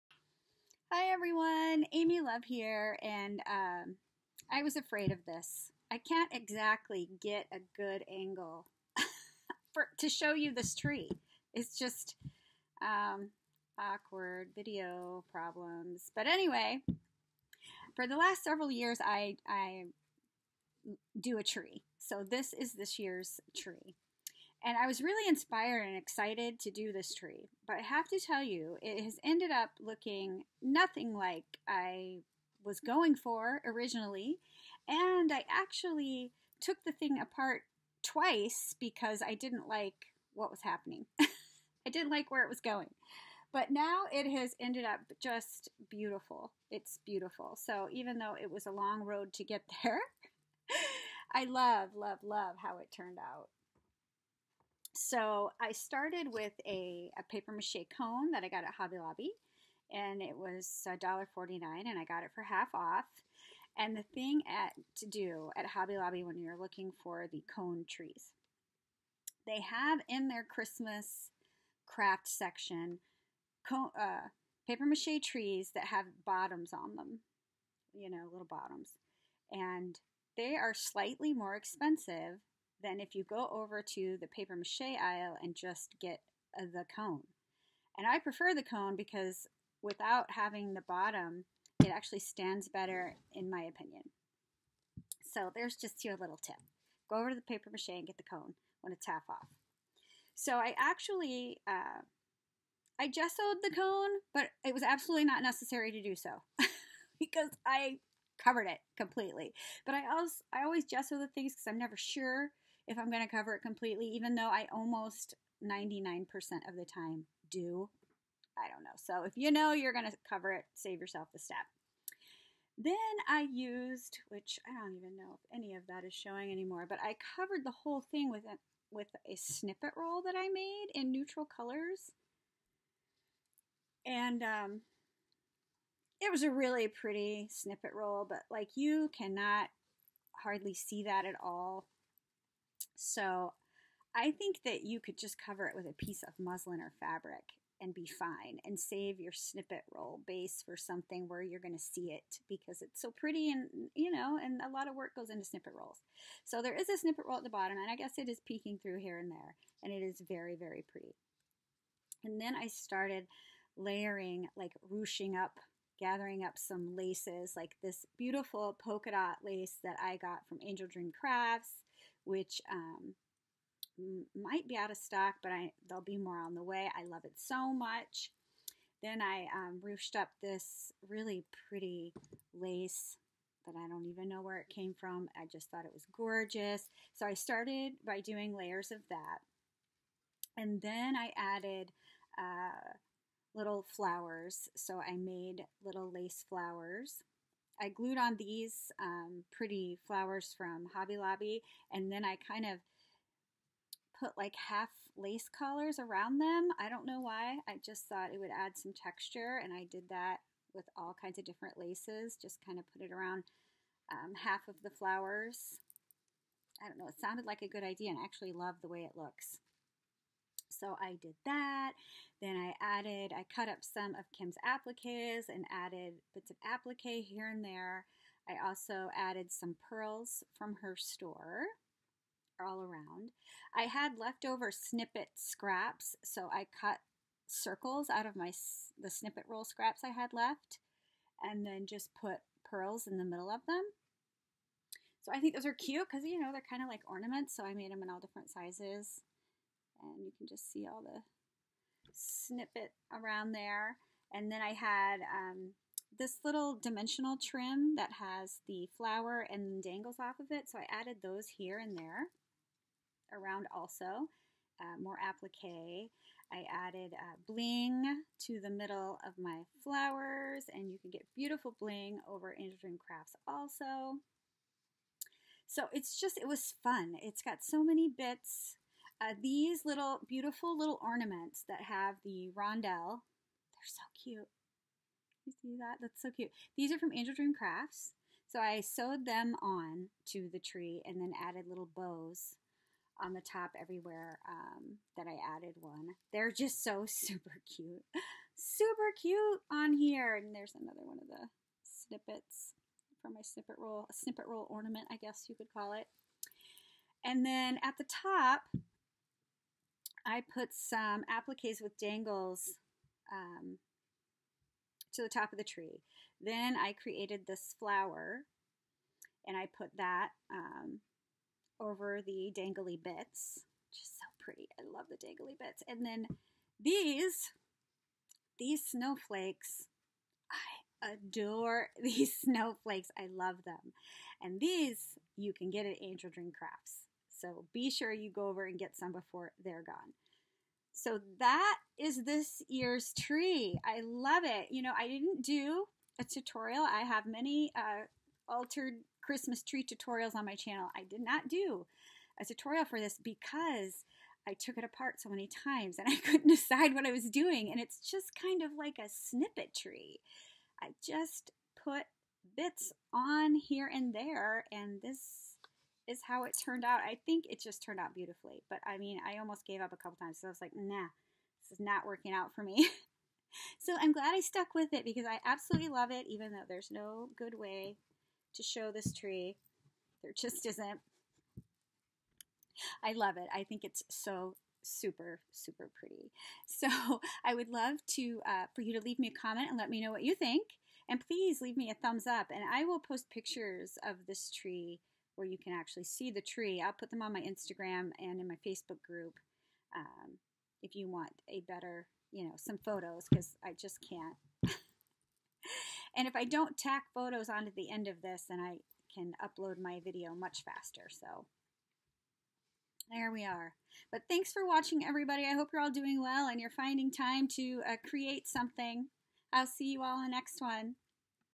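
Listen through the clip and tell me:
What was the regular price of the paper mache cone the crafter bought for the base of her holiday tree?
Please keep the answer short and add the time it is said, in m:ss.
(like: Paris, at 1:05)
$1.49, at 1:00.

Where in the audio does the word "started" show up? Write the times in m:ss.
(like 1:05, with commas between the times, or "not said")
0:55, 2:42, 3:07.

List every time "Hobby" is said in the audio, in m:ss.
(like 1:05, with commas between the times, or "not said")
0:58, 1:05, 3:20.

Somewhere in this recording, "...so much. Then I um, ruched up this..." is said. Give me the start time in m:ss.
2:57.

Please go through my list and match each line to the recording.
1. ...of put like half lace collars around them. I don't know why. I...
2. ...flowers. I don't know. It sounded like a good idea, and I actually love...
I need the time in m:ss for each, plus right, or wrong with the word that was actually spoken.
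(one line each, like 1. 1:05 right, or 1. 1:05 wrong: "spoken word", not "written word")
1. 3:22 right
2. 3:34 right.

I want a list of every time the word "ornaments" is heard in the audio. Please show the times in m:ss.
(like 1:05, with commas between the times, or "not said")
4:07, 4:41, 5:04.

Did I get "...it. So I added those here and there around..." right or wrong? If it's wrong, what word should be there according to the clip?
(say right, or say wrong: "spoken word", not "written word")
right.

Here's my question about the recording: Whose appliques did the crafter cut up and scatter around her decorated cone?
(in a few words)
Kim's.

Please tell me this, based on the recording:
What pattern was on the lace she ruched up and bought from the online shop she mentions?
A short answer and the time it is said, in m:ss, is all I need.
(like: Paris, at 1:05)
polka dot, at 2:48.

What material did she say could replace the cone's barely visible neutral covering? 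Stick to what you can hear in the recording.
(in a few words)
muslin.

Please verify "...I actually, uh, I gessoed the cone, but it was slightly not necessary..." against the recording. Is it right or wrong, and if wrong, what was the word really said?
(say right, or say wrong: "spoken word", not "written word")
wrong: "absolutely", not "slightly".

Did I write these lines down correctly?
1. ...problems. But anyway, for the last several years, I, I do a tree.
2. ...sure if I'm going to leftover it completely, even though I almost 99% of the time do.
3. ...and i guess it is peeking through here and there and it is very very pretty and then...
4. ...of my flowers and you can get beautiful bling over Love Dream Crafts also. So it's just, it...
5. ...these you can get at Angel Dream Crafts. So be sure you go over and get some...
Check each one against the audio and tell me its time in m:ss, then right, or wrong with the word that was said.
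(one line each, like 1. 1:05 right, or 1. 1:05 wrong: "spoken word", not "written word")
1. 0:15 right
2. 1:51 wrong: "cover", not "leftover"
3. 2:37 right
4. 4:29 wrong: "Angel", not "Love"
5. 5:34 right.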